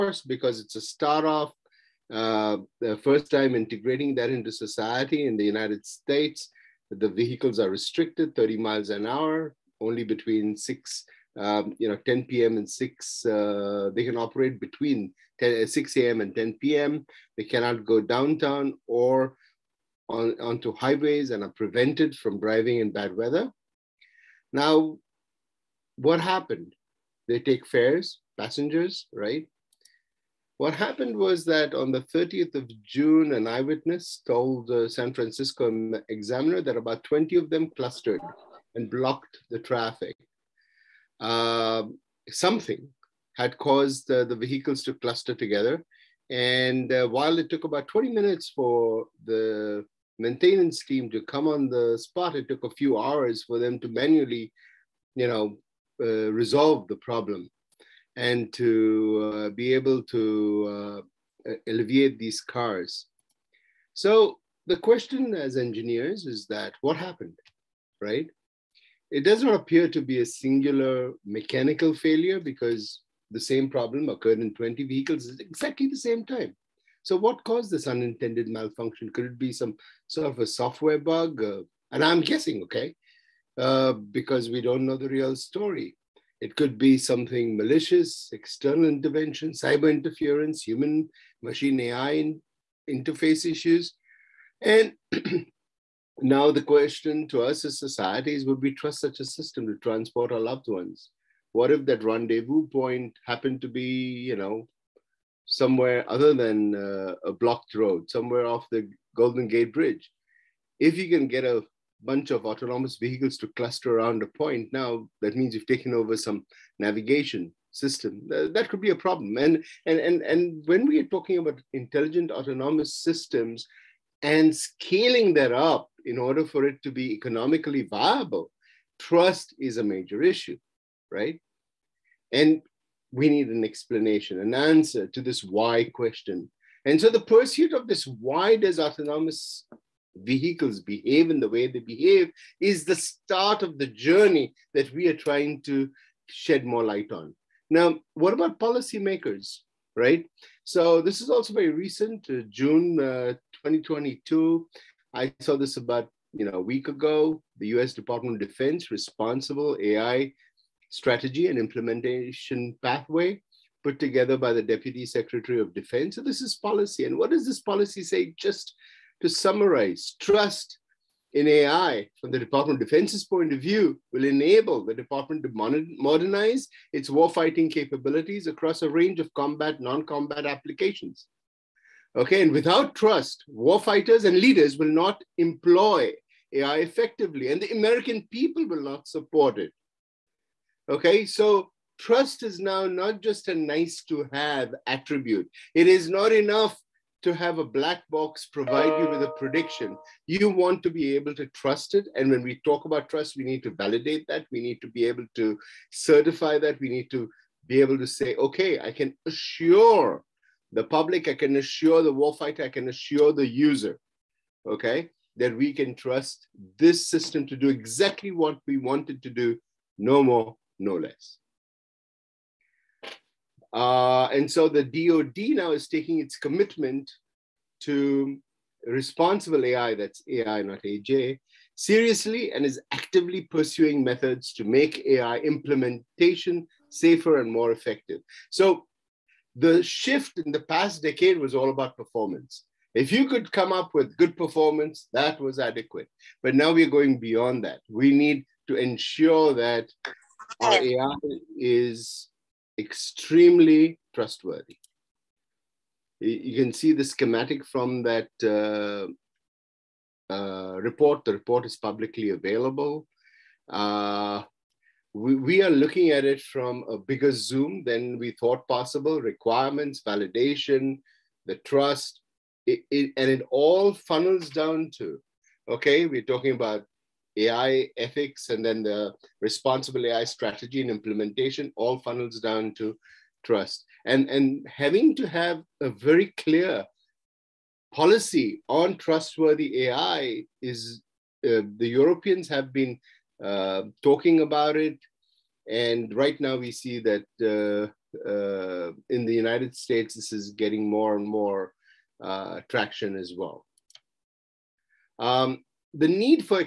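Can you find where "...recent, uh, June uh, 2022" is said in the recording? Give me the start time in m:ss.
2:31.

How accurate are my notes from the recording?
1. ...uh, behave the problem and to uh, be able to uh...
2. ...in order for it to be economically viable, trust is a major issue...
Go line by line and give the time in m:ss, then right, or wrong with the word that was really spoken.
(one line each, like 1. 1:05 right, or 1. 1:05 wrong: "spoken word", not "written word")
1. 0:56 wrong: "resolve", not "behave"
2. 2:06 right.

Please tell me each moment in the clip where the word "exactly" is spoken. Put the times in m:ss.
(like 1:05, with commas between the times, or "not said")
1:15, 3:37.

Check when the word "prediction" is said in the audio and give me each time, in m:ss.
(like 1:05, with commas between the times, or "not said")
3:19.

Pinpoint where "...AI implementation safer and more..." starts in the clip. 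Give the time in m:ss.
3:55.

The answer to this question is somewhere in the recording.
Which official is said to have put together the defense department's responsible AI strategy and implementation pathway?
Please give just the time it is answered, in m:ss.
2:44.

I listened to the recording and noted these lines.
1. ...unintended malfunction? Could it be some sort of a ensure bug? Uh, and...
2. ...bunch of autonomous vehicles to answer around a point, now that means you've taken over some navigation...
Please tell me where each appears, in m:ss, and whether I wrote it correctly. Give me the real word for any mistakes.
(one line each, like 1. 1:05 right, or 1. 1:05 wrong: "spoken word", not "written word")
1. 1:17 wrong: "software", not "ensure"
2. 1:52 wrong: "cluster", not "answer".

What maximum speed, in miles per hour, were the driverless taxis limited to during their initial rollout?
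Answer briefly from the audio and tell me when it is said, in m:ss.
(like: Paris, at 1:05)
30, at 0:08.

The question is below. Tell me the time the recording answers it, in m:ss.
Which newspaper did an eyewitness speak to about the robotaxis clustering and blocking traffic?
0:34.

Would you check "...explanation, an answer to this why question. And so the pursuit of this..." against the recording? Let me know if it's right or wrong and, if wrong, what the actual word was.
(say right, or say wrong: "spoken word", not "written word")
right.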